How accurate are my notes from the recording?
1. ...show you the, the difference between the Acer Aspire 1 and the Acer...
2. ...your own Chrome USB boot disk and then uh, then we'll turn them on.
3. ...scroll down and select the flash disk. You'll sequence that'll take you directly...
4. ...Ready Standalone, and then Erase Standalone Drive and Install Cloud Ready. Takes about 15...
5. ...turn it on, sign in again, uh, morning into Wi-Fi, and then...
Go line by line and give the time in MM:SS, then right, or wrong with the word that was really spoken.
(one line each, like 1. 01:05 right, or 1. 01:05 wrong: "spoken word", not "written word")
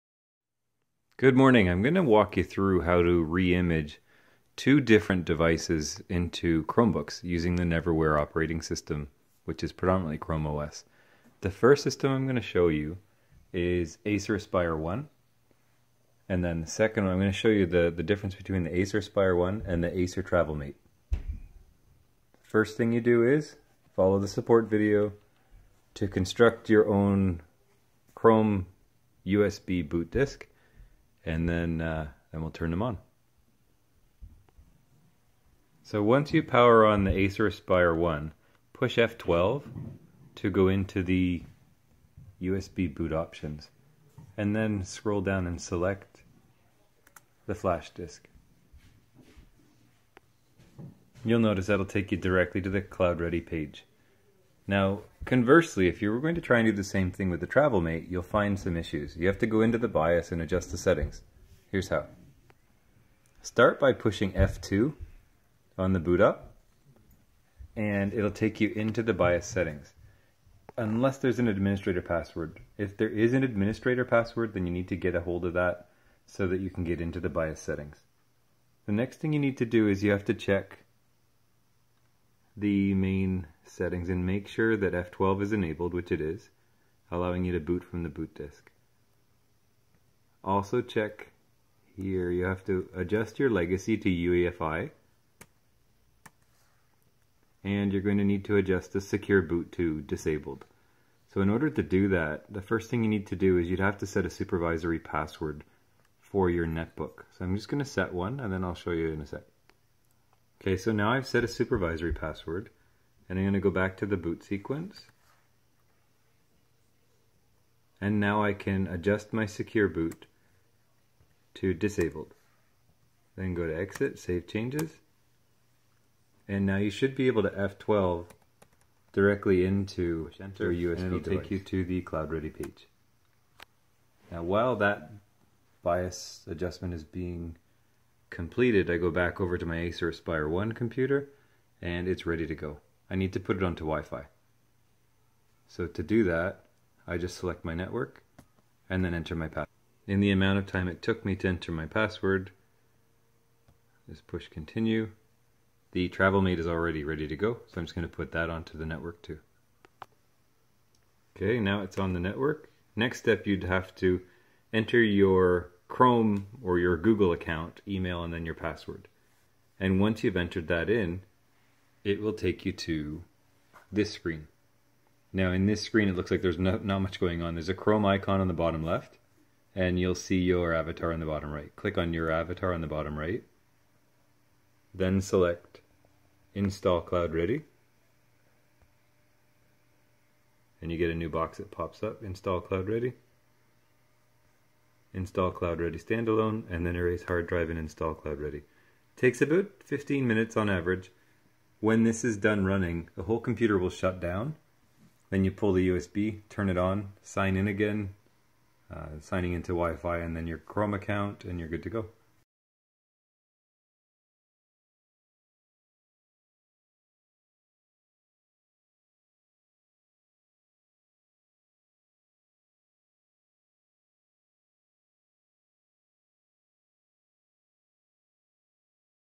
1. 00:17 right
2. 00:26 right
3. 00:44 wrong: "notice", not "sequence"
4. 03:15 wrong: "Hard", not "Standalone"
5. 03:26 wrong: "signing", not "morning".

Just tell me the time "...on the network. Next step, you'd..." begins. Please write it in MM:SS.
02:41.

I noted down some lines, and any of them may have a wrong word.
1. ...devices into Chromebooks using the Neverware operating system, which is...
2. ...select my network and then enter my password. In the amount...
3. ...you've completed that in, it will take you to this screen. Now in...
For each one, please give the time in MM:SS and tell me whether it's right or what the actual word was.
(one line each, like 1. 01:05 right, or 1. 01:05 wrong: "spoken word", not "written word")
1. 00:05 right
2. 02:27 right
3. 02:50 wrong: "entered", not "completed".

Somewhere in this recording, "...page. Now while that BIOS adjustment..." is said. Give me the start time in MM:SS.
02:12.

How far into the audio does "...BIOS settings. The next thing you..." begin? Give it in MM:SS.
01:17.